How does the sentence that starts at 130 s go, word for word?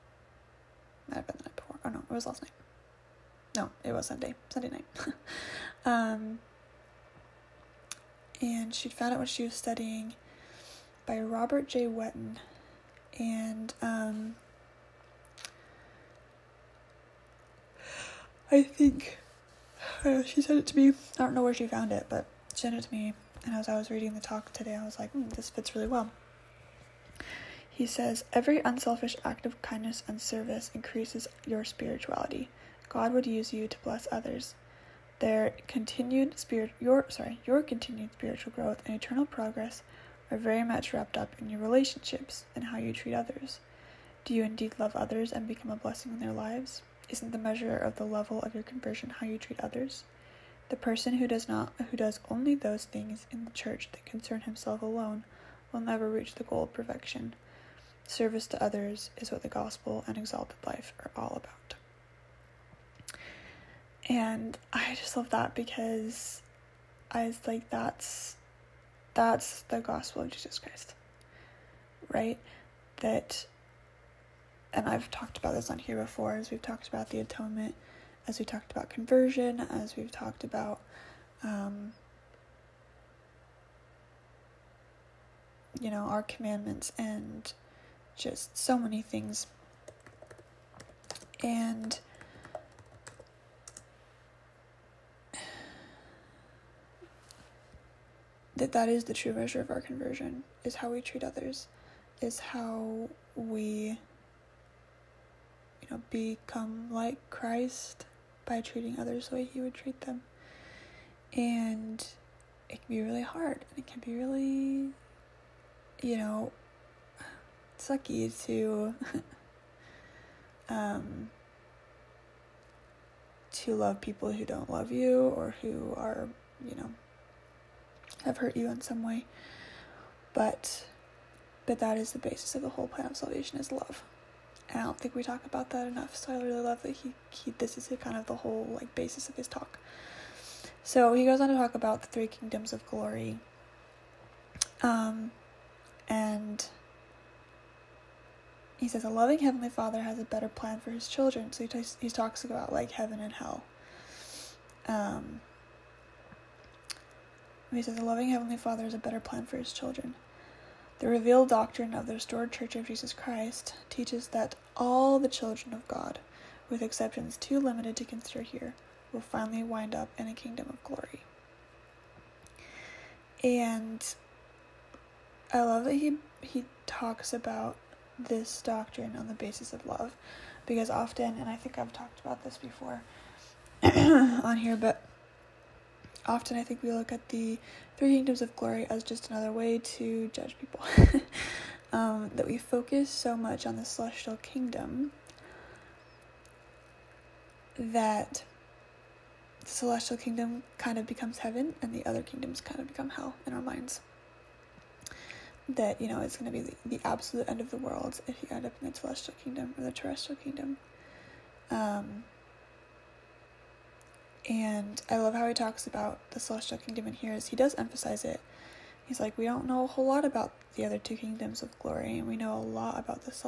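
But but that is the basis of the whole plan of salvation is love.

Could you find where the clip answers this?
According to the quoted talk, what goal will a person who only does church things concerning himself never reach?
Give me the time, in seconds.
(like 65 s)
56 s.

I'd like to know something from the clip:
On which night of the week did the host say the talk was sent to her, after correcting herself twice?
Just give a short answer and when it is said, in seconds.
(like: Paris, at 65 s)
Sunday, at 4 s.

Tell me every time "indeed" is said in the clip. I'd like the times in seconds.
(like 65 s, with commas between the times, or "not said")
44 s.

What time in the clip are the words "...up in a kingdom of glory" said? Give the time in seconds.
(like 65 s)
169 s.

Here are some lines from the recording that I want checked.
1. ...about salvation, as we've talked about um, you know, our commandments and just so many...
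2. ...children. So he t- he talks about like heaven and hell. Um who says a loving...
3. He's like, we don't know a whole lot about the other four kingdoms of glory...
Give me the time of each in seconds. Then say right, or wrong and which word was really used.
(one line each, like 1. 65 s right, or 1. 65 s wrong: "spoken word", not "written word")
1. 78 s wrong: "conversion", not "salvation"
2. 151 s right
3. 219 s wrong: "two", not "four".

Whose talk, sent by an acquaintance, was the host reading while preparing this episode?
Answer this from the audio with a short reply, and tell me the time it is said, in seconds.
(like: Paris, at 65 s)
Robert J. Whetten, at 11 s.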